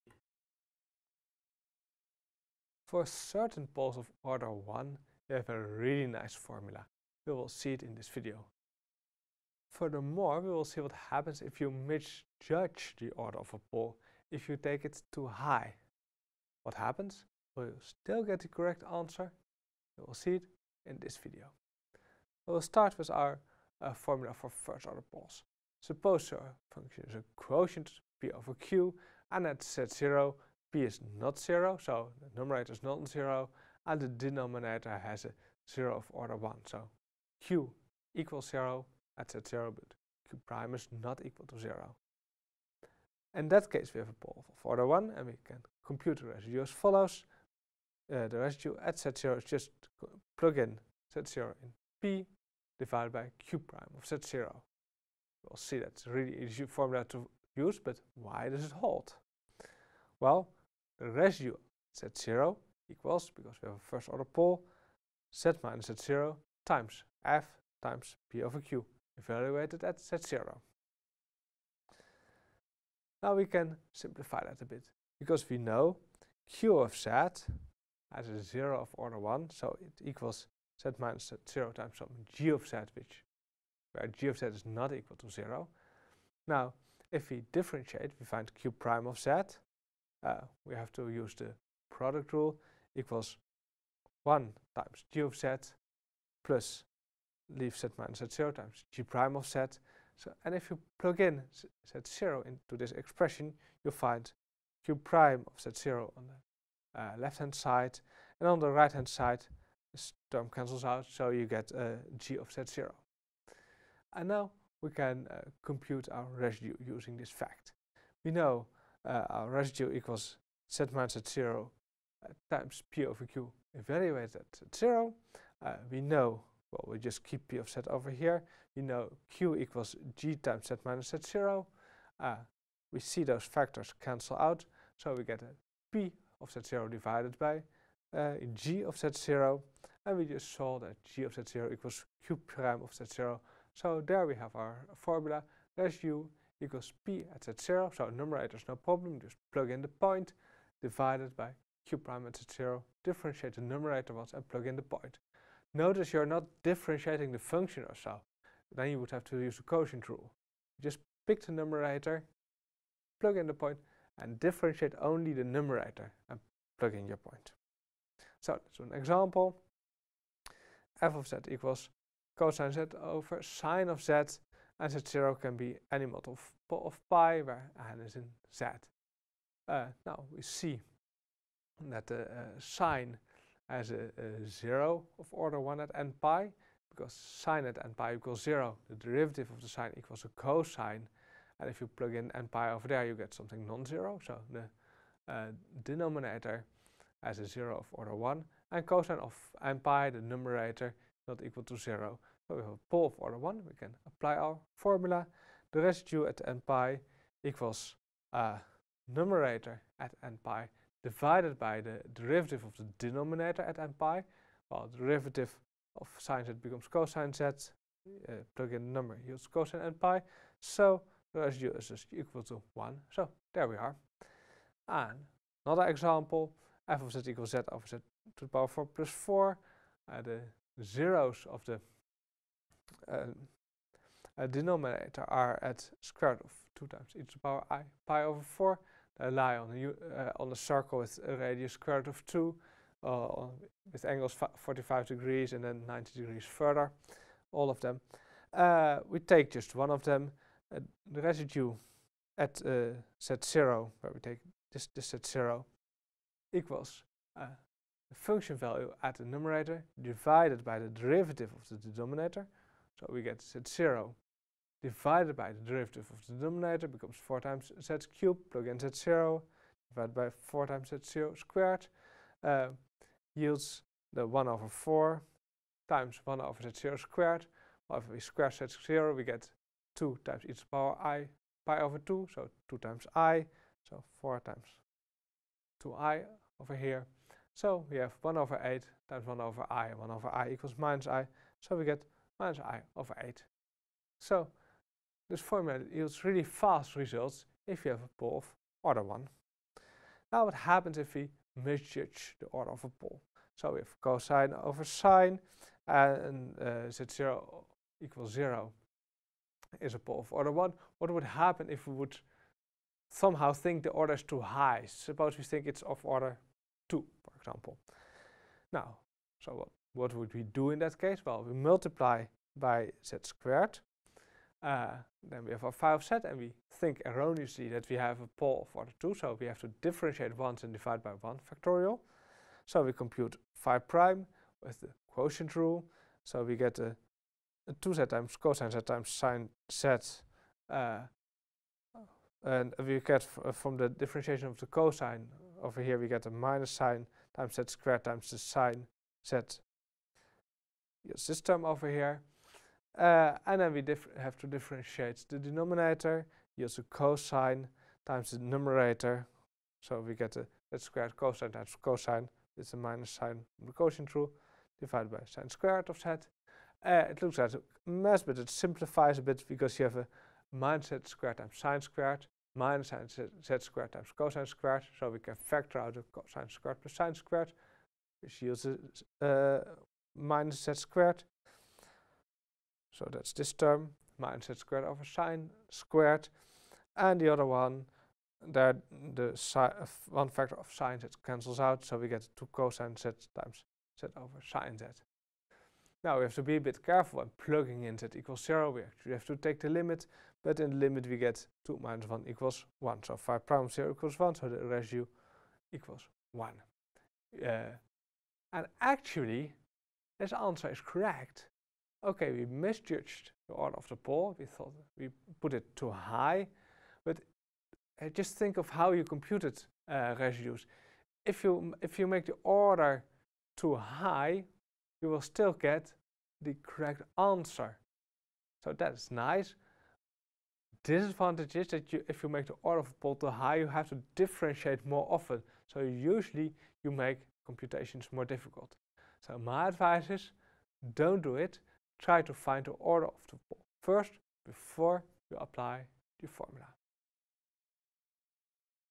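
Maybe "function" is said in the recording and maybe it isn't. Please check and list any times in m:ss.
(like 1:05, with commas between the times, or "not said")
0:26, 2:37, 4:18.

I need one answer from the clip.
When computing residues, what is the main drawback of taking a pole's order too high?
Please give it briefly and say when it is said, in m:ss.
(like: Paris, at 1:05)
differentiate more often, at 7:13.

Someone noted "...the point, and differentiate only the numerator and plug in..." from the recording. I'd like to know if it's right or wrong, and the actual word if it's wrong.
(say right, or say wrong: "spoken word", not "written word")
right.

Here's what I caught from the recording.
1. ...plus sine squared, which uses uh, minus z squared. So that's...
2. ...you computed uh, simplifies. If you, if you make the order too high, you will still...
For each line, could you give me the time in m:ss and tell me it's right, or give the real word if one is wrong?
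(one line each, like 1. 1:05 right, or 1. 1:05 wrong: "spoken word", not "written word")
1. 6:16 right
2. 6:58 wrong: "residues", not "simplifies".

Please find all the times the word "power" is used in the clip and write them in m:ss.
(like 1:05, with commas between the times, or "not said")
3:48, 3:57, 4:40.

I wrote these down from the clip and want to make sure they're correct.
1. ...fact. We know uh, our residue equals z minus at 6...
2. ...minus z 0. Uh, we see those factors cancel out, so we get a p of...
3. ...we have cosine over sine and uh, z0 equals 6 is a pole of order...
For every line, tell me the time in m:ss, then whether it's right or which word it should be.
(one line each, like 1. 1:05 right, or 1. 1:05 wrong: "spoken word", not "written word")
1. 1:57 wrong: "0", not "6"
2. 2:10 right
3. 5:03 wrong: "0", not "6".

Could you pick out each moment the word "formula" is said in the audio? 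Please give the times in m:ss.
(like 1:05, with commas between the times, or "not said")
0:06, 0:23, 0:56, 2:24, 3:24, 4:55, 7:26.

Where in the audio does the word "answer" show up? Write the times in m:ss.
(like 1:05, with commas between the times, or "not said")
0:18, 6:50, 7:07.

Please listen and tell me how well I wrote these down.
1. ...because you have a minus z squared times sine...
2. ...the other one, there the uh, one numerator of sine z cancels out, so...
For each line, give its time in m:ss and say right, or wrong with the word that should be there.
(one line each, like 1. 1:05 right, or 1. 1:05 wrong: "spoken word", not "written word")
1. 6:09 right
2. 6:27 wrong: "factor", not "numerator".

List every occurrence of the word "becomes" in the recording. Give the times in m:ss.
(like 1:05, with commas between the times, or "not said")
3:36, 4:26.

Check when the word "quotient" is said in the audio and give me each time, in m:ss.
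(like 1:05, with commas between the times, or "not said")
0:27, 2:39, 5:35, 6:03.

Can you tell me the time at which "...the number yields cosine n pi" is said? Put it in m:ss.
3:38.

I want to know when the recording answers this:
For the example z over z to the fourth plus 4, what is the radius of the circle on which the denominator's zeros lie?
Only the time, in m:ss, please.
4:01.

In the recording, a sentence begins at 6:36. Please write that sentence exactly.
Now we have to be a bit careful when plugging in z equals 0.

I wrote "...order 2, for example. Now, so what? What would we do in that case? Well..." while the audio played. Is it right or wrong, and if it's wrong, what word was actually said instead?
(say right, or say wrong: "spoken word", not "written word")
right.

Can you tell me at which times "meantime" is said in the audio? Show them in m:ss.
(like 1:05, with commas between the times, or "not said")
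not said.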